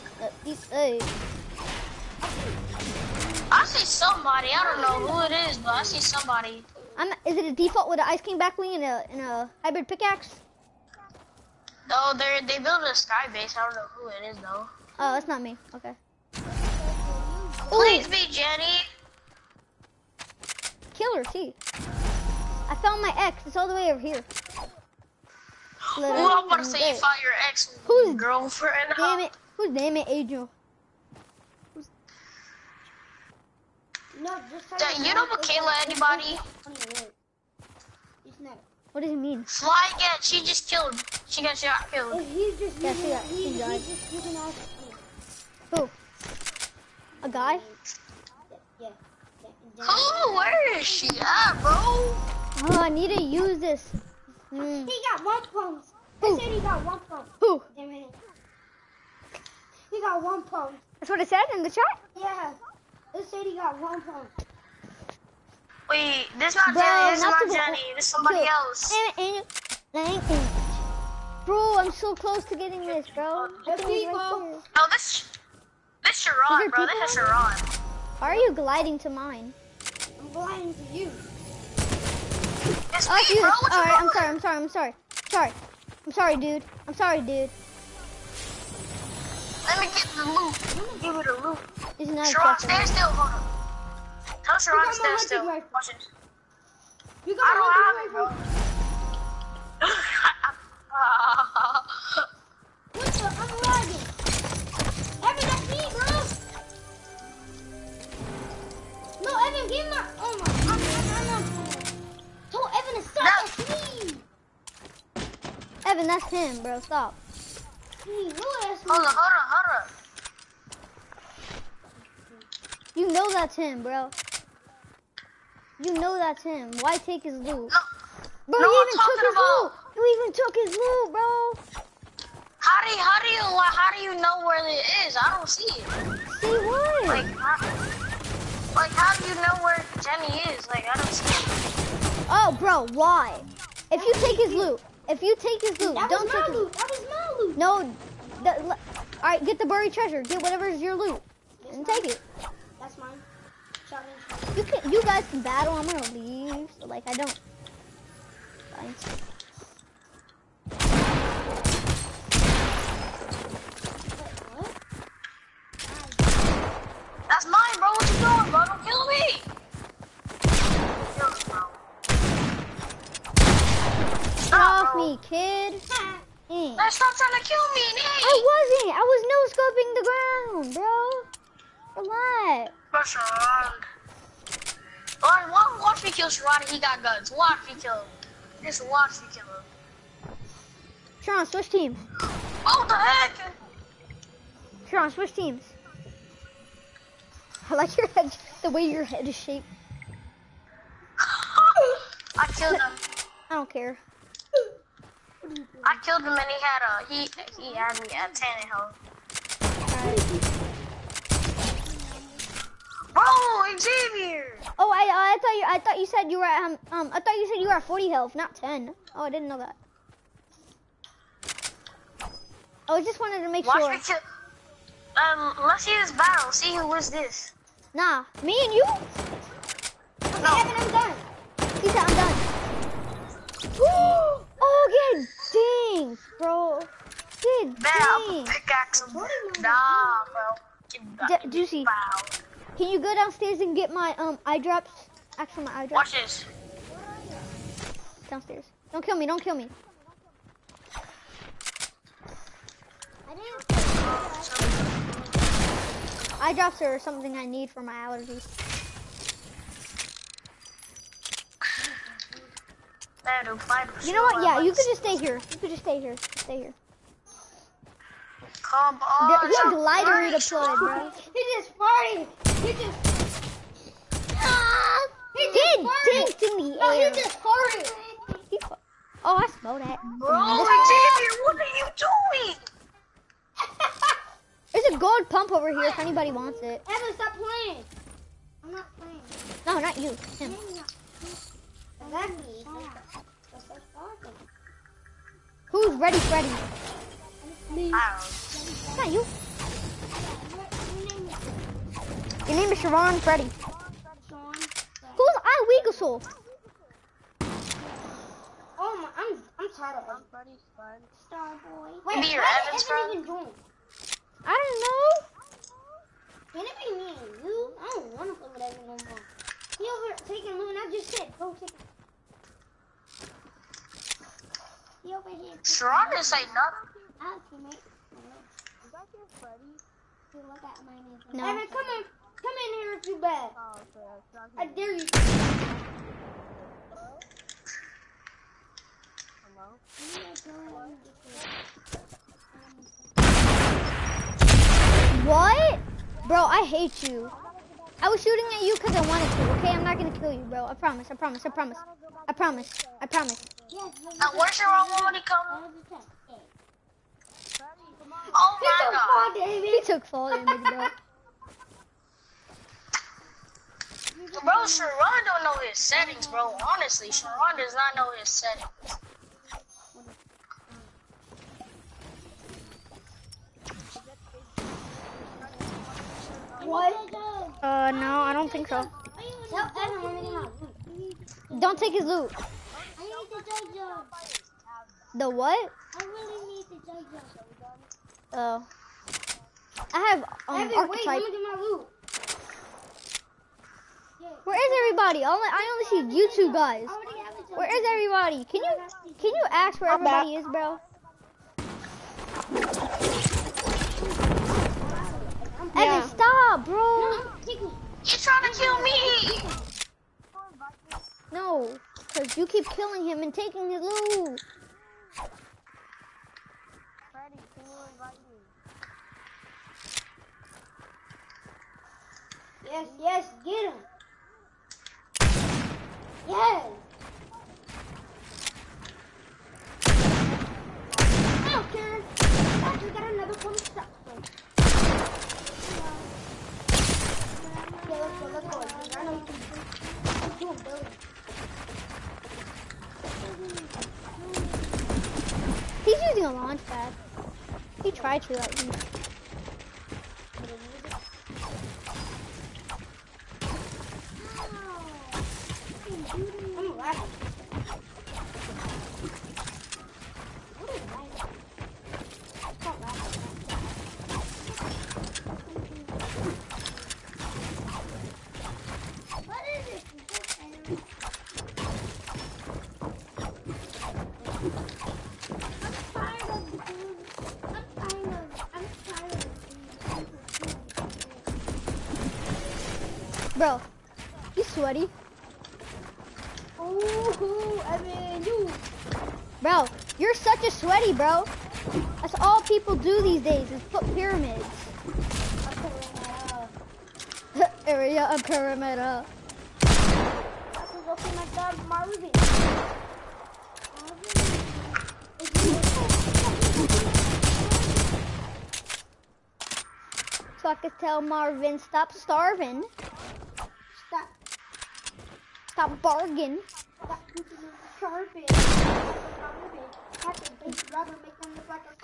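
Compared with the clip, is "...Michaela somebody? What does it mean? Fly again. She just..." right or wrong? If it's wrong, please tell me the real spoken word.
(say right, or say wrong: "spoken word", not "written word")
wrong: "anybody", not "somebody".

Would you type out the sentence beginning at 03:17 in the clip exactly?
I like your head, the way your head is shaped.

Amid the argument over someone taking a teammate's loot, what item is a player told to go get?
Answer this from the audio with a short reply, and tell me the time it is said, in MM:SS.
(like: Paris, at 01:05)
buried treasure, at 02:29.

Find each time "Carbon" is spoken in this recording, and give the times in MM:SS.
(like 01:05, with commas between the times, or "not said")
08:37.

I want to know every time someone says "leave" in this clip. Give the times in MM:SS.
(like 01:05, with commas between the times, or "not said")
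02:36.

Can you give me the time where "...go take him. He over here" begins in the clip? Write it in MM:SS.
05:21.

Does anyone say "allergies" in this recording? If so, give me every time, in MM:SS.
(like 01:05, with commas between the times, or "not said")
04:17.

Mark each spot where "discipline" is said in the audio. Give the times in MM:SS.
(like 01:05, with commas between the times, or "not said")
not said.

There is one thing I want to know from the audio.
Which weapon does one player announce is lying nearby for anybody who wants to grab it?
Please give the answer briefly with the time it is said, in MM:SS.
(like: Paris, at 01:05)
gold pump, at 04:44.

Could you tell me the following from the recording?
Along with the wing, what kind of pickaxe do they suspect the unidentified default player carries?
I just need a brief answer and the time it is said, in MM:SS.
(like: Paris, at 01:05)
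hybrid pickaxe, at 00:09.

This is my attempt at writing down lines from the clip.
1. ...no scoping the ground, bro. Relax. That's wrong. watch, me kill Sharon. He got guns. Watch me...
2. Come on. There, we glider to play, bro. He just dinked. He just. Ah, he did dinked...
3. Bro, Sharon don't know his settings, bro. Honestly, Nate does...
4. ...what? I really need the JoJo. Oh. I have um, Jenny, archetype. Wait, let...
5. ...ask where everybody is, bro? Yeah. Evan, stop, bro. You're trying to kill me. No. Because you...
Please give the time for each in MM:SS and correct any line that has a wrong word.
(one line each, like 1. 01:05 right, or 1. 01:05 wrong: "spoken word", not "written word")
1. 02:59 right
2. 04:28 wrong: "farted", not "dinked"
3. 06:04 wrong: "Sharon", not "Nate"
4. 06:25 wrong: "Evan", not "Jenny"
5. 06:39 right.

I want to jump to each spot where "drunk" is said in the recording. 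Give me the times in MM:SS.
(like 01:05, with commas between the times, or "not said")
not said.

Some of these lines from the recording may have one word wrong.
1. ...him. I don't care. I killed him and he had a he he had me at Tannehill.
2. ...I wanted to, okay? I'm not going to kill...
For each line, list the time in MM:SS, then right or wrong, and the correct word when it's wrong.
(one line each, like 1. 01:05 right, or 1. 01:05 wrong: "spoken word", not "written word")
1. 03:22 right
2. 05:48 right.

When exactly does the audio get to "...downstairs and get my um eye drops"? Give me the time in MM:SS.
04:03.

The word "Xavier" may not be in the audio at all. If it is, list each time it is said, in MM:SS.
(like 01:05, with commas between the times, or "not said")
03:33, 04:40.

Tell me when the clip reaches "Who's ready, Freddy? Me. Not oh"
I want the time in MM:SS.
04:55.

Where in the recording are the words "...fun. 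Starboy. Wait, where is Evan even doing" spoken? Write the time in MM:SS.
05:10.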